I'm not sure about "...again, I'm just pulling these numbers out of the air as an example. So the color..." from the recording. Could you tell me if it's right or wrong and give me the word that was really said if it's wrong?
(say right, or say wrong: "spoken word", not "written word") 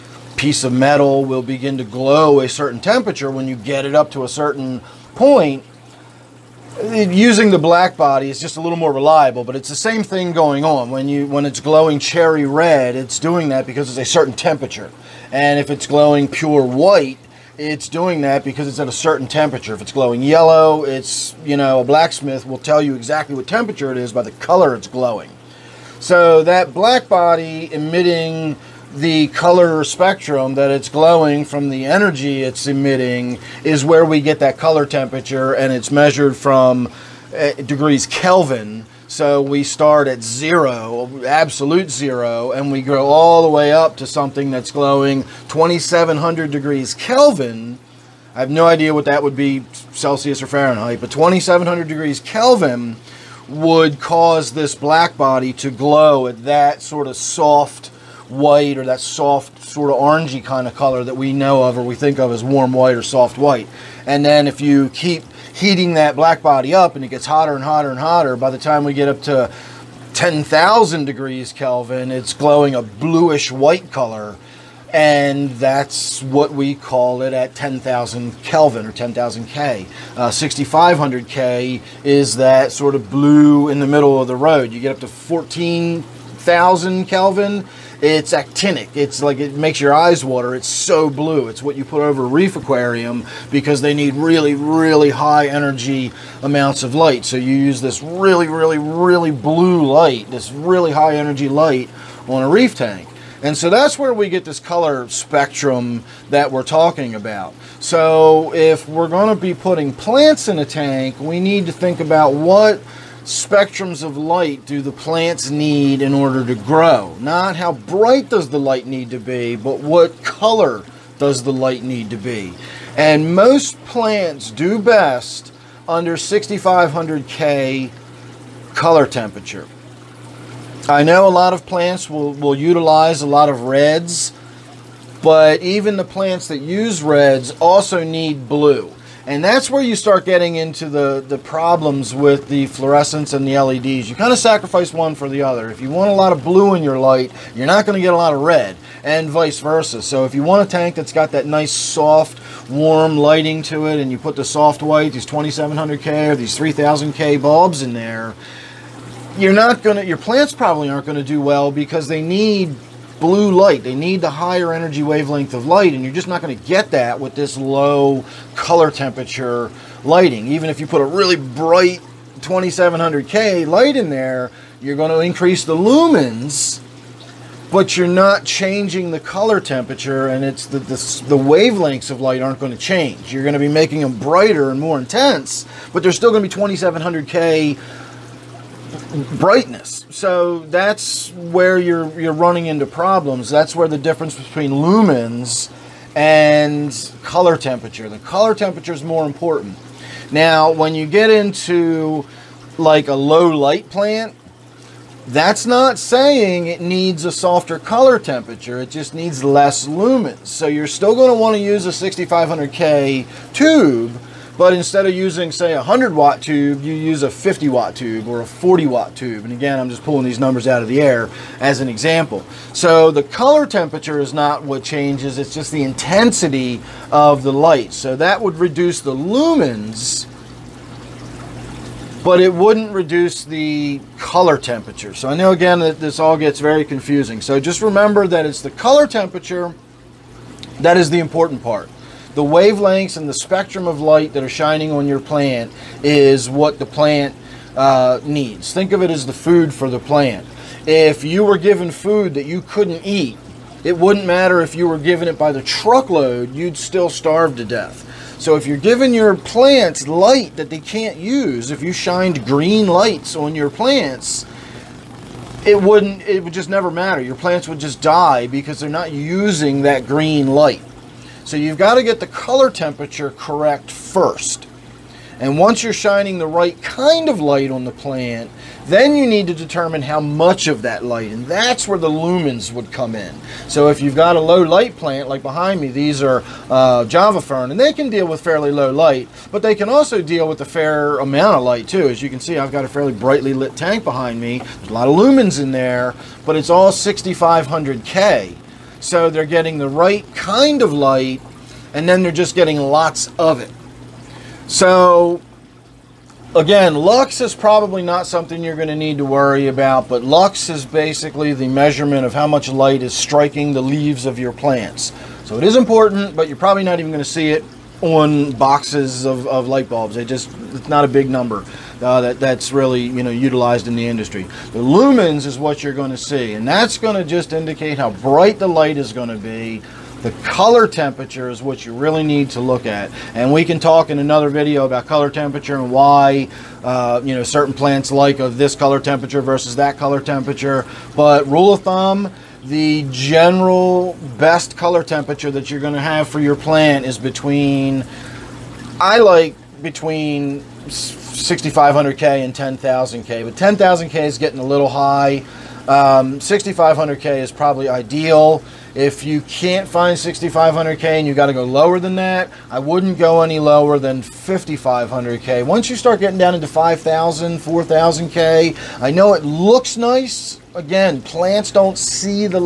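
right.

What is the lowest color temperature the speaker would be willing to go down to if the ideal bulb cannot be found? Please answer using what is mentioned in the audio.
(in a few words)
5,500K.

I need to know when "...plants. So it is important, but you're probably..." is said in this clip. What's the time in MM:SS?
05:14.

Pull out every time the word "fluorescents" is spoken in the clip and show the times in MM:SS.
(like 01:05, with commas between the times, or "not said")
02:22.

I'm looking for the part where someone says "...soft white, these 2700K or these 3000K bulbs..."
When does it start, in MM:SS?
02:34.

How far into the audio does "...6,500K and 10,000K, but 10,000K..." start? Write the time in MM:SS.
05:51.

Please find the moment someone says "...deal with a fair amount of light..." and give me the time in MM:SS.
04:50.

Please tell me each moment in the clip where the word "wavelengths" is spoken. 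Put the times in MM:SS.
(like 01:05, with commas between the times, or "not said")
02:45, 03:01, 04:02.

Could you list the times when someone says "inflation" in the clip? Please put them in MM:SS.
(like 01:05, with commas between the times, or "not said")
not said.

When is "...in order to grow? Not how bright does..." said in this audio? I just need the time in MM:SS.
01:56.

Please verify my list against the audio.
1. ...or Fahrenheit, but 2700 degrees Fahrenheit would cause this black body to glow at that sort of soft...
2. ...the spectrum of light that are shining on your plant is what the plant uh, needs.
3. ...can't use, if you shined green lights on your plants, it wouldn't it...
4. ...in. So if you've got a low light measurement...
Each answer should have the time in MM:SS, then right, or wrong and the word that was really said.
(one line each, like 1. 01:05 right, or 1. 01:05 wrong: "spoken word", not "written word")
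1. 00:50 wrong: "Kelvin", not "Fahrenheit"
2. 04:03 right
3. 04:20 right
4. 04:43 wrong: "plant", not "measurement".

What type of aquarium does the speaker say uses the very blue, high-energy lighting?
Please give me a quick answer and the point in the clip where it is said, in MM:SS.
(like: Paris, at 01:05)
reef aquarium, at 01:32.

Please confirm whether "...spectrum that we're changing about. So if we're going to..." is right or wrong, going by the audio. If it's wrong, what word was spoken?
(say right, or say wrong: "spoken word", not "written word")
wrong: "talking", not "changing".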